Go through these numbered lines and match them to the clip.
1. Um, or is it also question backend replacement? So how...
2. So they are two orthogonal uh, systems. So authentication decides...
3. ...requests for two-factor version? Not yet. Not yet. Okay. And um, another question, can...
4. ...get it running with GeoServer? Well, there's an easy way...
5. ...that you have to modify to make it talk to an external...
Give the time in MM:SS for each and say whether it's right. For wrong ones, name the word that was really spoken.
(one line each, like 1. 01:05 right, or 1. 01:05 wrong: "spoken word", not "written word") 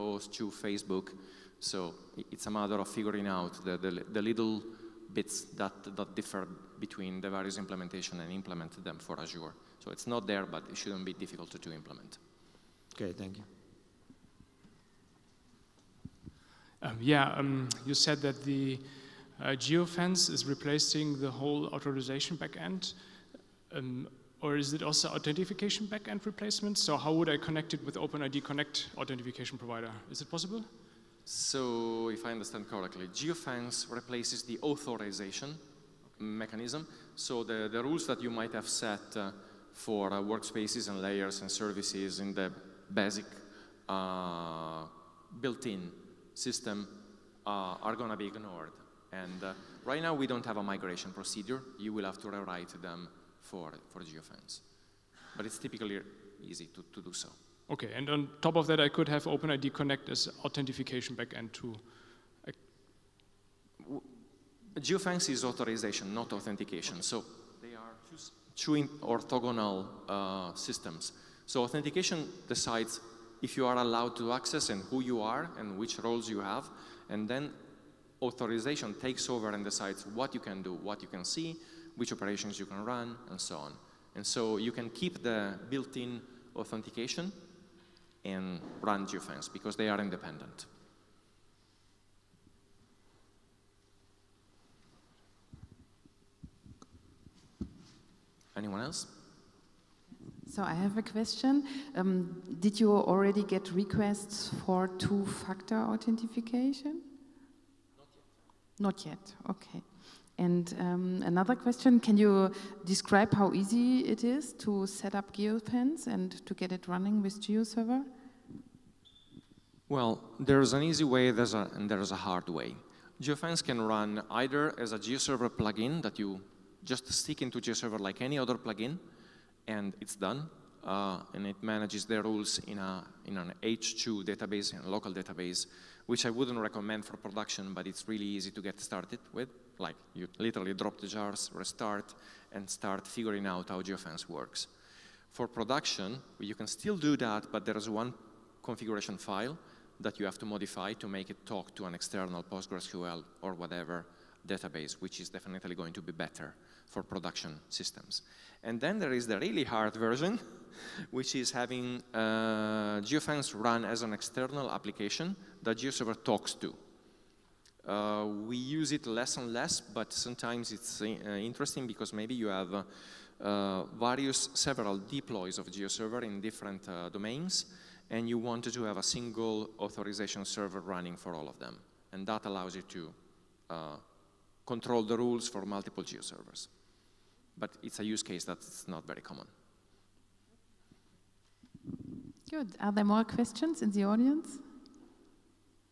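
1. 00:23 wrong: "authentication", not "question"
2. 01:07 right
3. 01:43 wrong: "authentication", not "version"
4. 01:56 right
5. 02:30 right.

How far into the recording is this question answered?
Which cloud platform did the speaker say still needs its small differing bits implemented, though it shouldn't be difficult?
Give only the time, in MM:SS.
00:09.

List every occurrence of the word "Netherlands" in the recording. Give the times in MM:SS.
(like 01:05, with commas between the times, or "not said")
not said.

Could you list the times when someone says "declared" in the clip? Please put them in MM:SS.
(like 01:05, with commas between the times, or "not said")
not said.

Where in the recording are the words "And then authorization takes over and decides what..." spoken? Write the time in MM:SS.
01:17.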